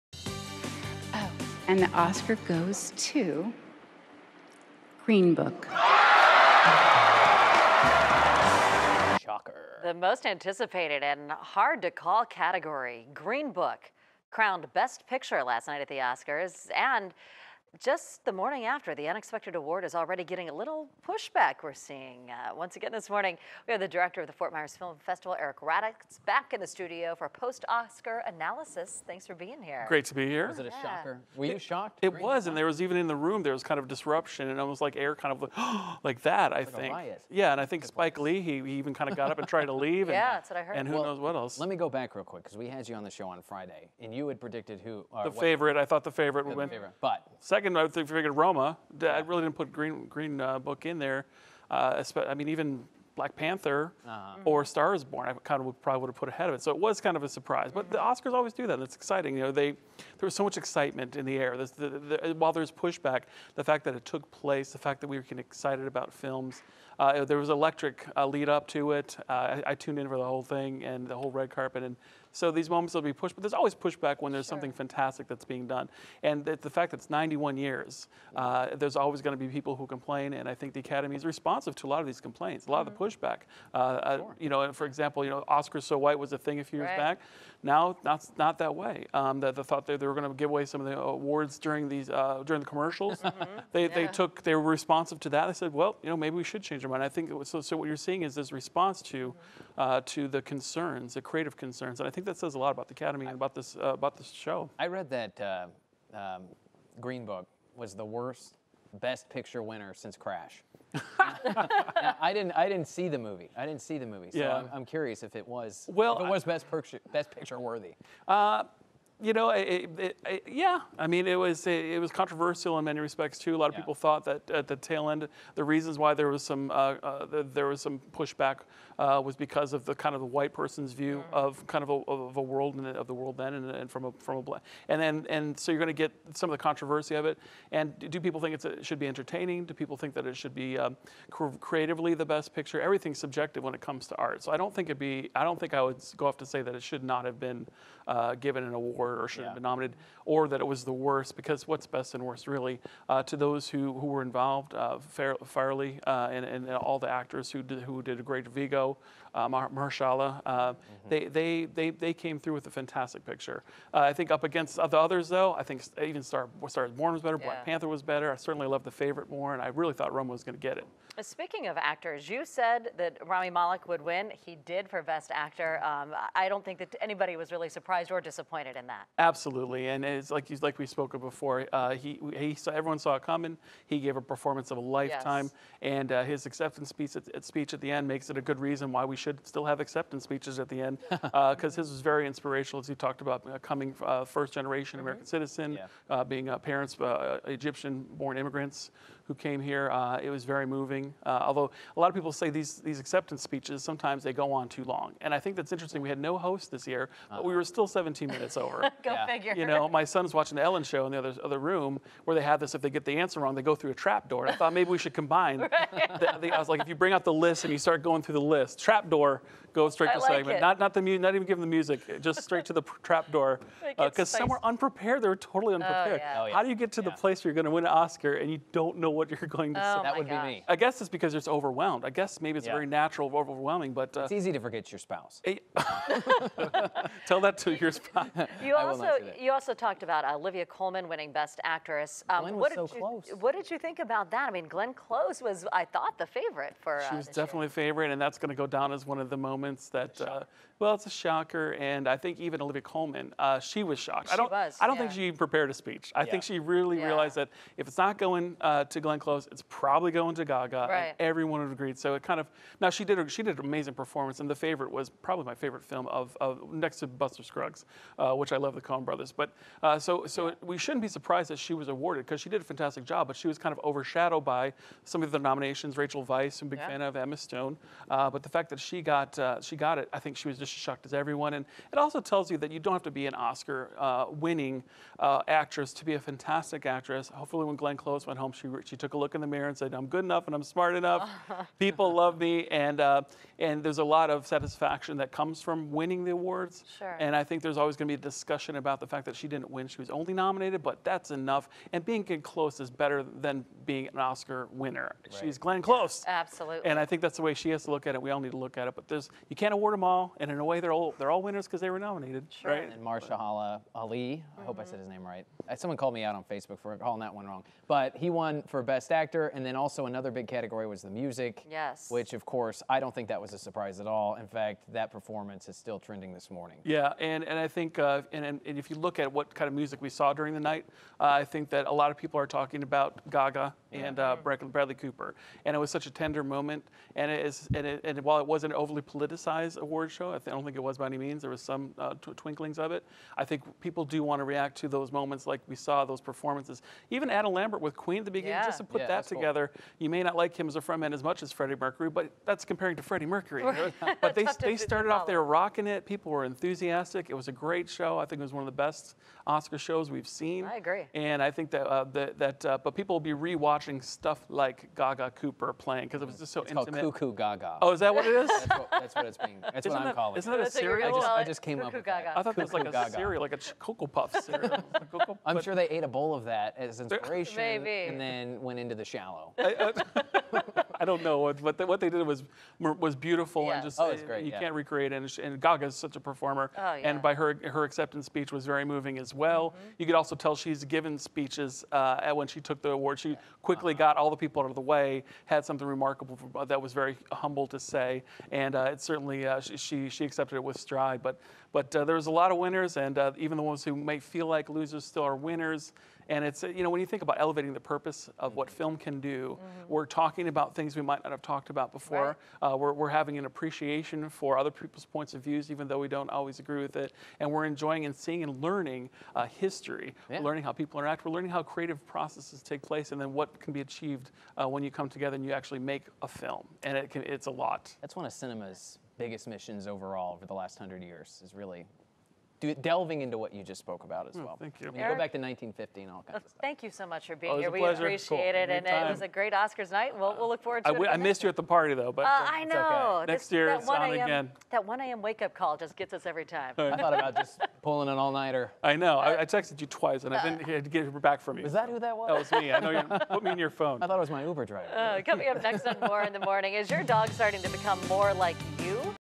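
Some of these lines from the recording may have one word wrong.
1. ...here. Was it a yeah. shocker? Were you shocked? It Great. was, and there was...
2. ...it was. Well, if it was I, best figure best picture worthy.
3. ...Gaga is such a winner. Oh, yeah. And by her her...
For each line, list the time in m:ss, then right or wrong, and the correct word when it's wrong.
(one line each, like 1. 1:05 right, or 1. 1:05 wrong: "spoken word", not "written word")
1. 0:30 right
2. 1:55 wrong: "picture", not "figure"
3. 6:25 wrong: "performer", not "winner".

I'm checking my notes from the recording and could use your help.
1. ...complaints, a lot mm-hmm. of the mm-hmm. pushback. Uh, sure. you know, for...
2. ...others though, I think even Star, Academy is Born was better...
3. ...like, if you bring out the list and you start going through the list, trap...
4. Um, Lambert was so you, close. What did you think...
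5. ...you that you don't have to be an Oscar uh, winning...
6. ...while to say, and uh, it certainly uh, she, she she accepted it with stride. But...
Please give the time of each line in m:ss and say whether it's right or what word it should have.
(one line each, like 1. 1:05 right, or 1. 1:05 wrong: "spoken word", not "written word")
1. 1:22 right
2. 2:44 wrong: "Star", not "Academy"
3. 3:36 right
4. 4:02 wrong: "Glenn", not "Lambert"
5. 4:42 right
6. 6:37 wrong: "humble", not "while".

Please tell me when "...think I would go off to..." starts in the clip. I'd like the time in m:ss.
2:25.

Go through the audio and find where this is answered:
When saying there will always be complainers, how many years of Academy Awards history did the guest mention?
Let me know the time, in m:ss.
1:17.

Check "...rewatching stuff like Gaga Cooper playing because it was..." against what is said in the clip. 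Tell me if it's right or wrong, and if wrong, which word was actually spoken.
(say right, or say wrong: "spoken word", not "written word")
right.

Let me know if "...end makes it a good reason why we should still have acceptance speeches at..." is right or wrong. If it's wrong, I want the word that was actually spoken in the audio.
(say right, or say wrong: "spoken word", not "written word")
right.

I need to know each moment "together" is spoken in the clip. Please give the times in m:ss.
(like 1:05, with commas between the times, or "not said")
5:49, 7:05.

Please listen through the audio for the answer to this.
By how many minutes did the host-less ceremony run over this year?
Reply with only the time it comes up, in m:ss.
3:27.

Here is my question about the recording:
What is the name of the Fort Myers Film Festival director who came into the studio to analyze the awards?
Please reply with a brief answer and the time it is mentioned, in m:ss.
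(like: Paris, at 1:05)
Eric Raddatz, at 0:25.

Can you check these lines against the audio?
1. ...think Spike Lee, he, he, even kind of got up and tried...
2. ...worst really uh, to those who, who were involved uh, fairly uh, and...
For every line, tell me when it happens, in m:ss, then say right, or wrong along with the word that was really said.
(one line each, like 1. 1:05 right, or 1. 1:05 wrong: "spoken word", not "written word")
1. 0:37 right
2. 2:32 right.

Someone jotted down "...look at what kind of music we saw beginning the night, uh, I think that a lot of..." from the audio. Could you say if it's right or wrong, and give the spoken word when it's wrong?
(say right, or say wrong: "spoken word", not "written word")
wrong: "during", not "beginning".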